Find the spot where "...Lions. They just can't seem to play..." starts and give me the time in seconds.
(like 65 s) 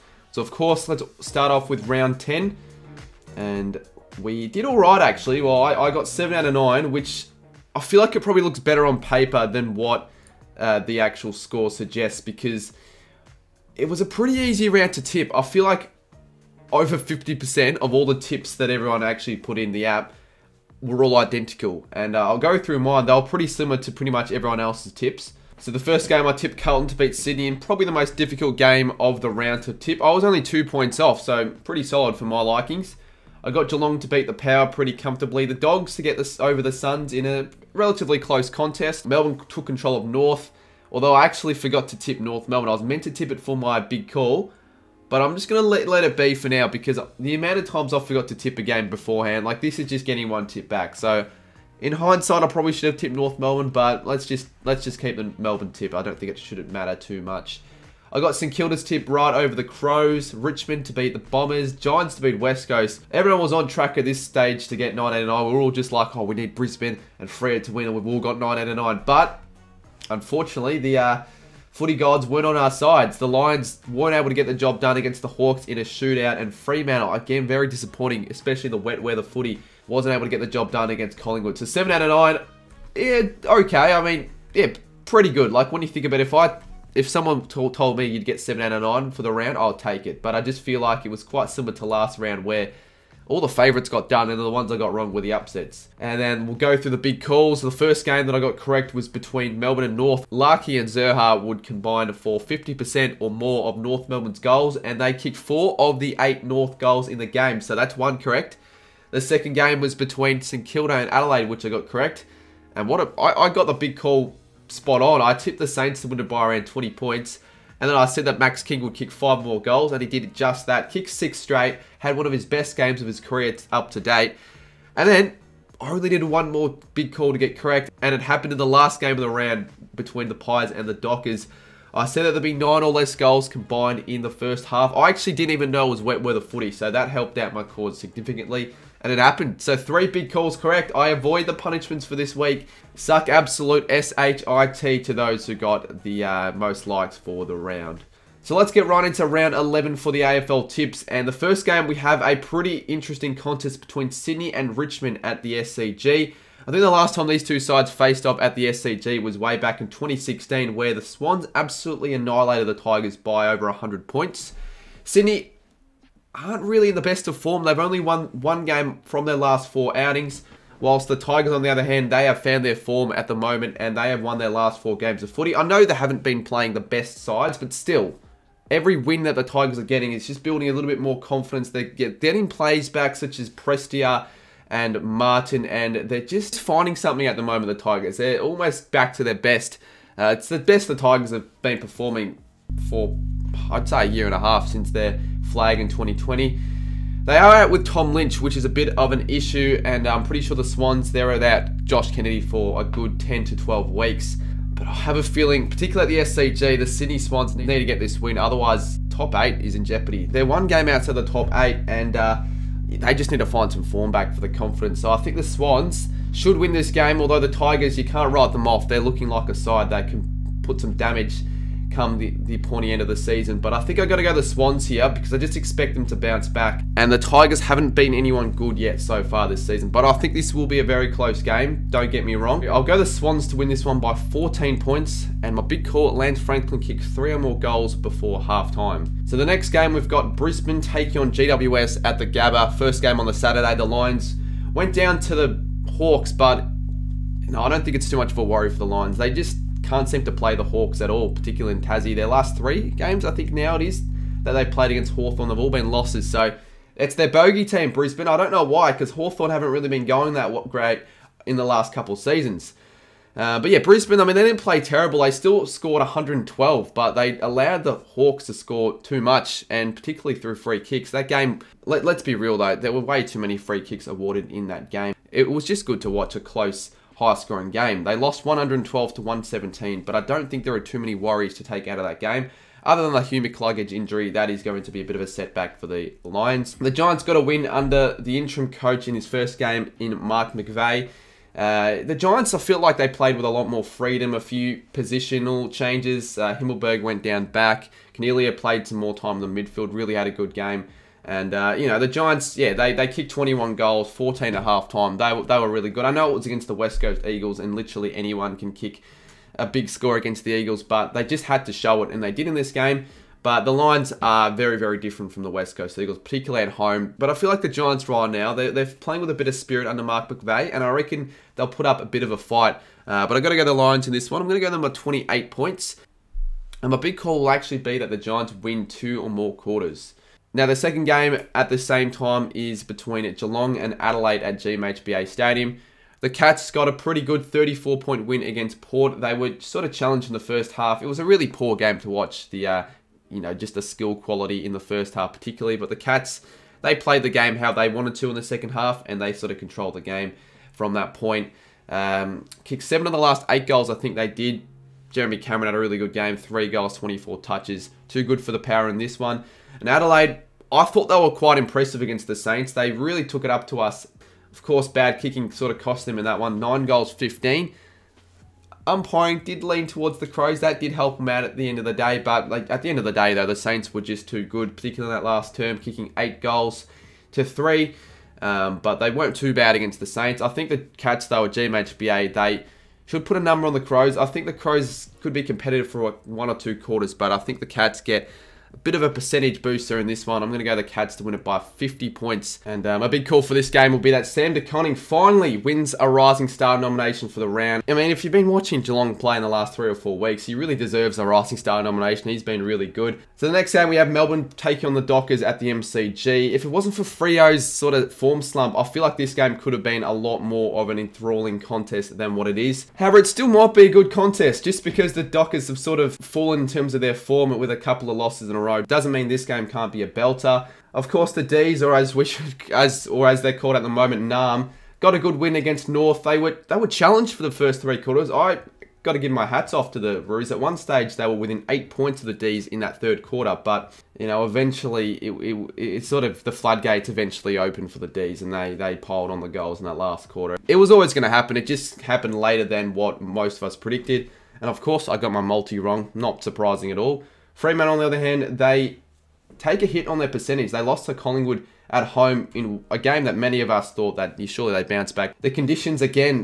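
248 s.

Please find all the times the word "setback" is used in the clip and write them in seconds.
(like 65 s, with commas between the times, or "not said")
285 s.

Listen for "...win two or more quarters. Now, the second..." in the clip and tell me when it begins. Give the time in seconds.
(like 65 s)
328 s.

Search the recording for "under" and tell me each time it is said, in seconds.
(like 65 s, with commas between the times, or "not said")
287 s, 319 s.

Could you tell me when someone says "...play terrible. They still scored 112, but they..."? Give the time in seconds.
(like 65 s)
264 s.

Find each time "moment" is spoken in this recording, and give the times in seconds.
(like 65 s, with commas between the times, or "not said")
173 s, 187 s, 423 s.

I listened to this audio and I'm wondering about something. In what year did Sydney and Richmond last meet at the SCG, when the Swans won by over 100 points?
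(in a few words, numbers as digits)
2016.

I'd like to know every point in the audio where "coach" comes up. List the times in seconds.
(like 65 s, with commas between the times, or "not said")
288 s.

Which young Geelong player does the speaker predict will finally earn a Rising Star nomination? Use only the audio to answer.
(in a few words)
Sam De Koning.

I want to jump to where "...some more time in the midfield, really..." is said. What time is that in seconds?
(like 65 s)
298 s.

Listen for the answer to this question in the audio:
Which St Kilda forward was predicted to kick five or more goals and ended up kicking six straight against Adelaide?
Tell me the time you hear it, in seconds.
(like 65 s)
118 s.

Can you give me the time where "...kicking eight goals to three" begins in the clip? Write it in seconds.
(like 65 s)
375 s.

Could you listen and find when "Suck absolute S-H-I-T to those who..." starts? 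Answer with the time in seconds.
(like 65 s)
142 s.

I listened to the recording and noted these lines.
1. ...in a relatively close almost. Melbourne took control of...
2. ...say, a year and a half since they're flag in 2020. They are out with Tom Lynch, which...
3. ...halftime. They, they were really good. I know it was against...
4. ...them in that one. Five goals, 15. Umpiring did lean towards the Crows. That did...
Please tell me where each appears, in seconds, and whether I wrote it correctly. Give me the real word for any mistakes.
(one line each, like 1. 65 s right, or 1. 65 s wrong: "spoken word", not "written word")
1. 37 s wrong: "contest", not "almost"
2. 193 s right
3. 304 s right
4. 366 s wrong: "Nine", not "Five".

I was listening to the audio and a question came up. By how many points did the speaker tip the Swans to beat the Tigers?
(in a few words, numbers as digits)
14.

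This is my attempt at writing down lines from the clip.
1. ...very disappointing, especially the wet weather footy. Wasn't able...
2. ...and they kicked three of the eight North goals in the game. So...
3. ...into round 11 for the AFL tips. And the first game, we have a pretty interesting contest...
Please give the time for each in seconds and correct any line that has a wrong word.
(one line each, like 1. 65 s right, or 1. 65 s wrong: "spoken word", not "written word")
1. 77 s right
2. 104 s wrong: "four", not "three"
3. 149 s right.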